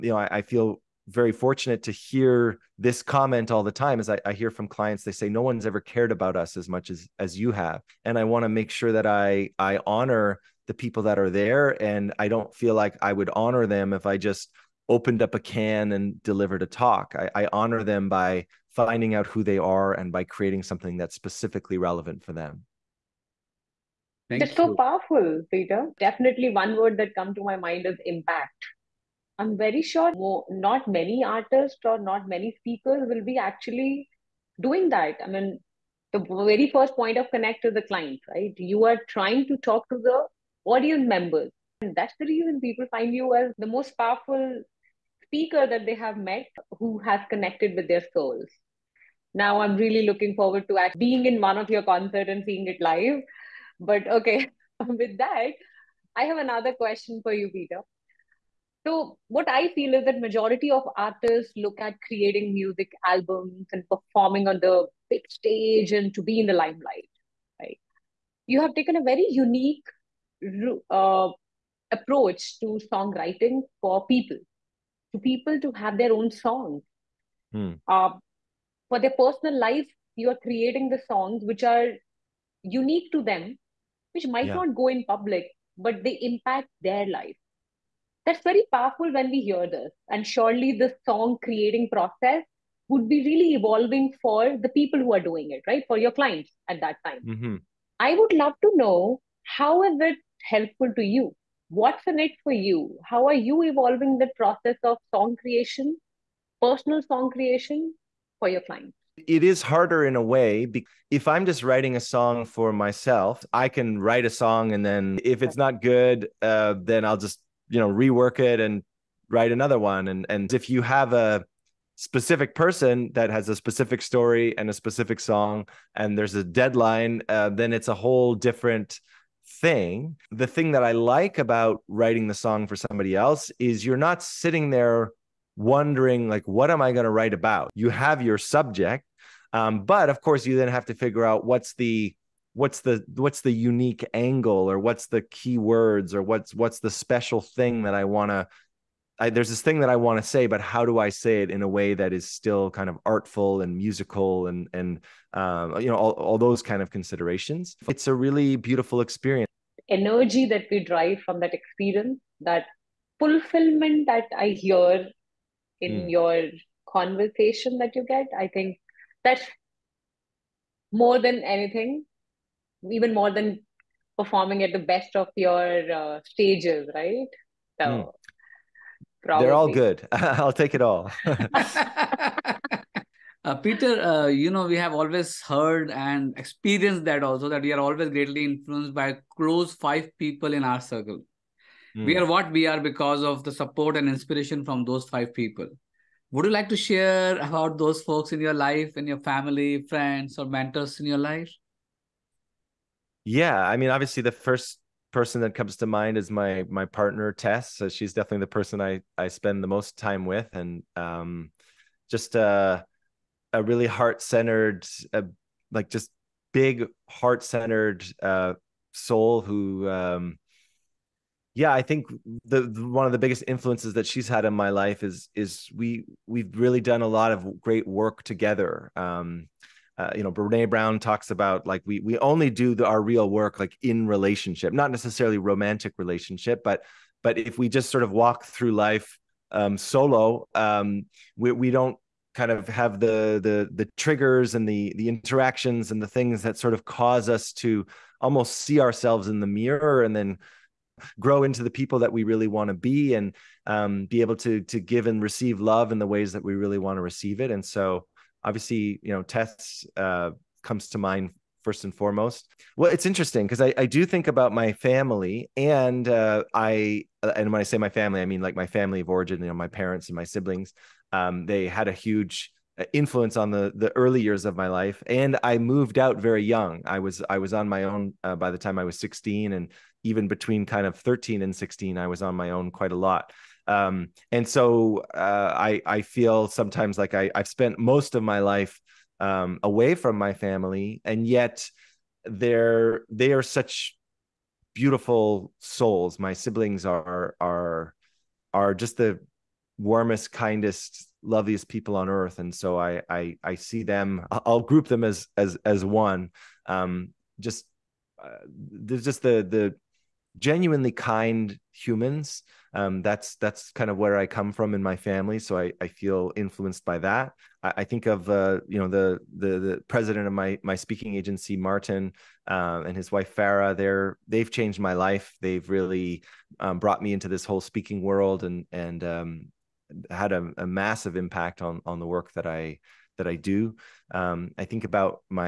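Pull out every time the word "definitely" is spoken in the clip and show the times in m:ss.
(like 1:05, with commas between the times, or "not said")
0:25, 3:28.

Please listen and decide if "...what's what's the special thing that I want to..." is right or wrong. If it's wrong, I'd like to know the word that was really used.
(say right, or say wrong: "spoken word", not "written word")
right.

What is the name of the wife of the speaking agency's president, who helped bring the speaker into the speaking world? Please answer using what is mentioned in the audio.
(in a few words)
Farah.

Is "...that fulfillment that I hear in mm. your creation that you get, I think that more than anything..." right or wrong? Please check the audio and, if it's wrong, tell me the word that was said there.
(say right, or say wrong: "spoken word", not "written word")
wrong: "conversation", not "creation".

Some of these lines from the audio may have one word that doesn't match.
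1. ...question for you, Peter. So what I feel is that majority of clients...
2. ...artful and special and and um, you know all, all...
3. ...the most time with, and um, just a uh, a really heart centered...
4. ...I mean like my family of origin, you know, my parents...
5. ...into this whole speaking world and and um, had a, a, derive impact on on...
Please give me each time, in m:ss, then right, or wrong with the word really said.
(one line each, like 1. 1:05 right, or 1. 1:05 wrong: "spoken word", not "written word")
1. 0:56 wrong: "artists", not "clients"
2. 2:33 wrong: "musical", not "special"
3. 3:29 right
4. 4:28 right
5. 5:27 wrong: "massive", not "derive".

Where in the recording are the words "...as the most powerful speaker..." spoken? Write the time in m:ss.
0:43.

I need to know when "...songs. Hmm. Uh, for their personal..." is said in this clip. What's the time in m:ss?
1:16.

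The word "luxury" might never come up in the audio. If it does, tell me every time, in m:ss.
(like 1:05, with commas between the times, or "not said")
not said.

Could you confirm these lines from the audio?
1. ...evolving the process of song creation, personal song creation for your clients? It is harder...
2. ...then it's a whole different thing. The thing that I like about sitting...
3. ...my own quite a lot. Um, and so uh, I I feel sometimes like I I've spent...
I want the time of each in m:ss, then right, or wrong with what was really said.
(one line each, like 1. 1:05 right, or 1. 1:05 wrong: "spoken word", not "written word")
1. 1:43 right
2. 2:07 wrong: "writing", not "sitting"
3. 4:42 right.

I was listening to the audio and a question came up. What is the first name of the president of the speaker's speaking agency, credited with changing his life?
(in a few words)
Martin.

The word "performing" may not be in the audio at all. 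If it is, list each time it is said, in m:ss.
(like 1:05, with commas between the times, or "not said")
1:03, 2:54.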